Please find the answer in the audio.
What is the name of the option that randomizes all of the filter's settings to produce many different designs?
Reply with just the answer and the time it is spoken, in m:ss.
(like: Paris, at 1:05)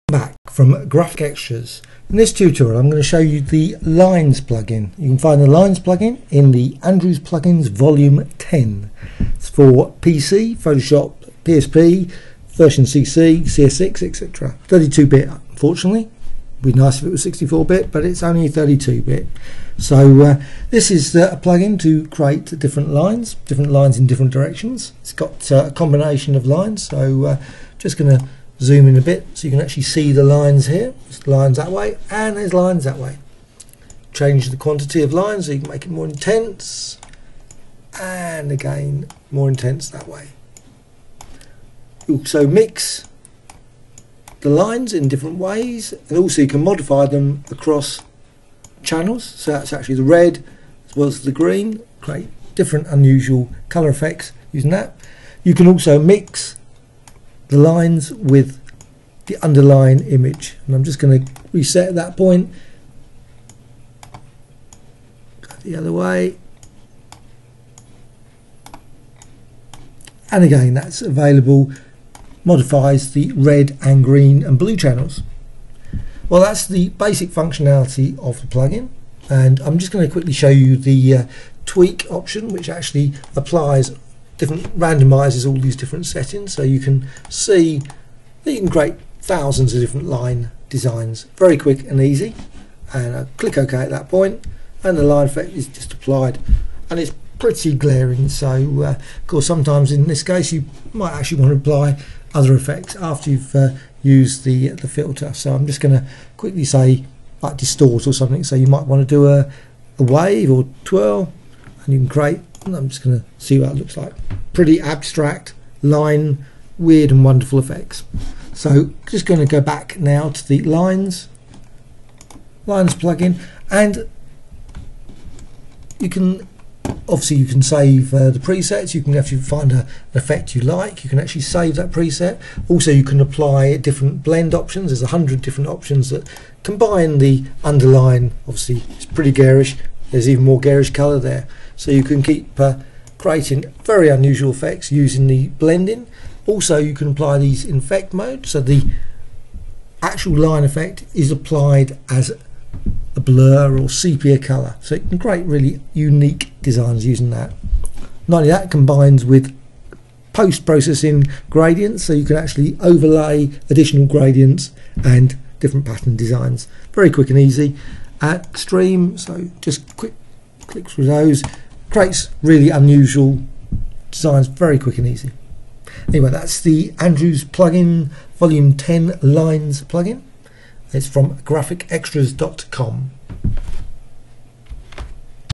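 tweak, at 1:21.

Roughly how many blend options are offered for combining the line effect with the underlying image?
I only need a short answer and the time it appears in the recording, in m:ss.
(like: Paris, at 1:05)
100, at 2:15.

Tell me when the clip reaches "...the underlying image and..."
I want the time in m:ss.
0:59.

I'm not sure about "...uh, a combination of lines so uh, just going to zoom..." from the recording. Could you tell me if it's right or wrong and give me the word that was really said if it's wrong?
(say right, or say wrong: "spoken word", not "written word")
right.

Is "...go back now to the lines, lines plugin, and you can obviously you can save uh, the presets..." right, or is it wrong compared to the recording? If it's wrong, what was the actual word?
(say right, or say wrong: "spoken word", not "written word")
right.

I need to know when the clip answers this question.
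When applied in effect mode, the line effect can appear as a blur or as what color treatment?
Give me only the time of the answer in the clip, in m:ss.
2:33.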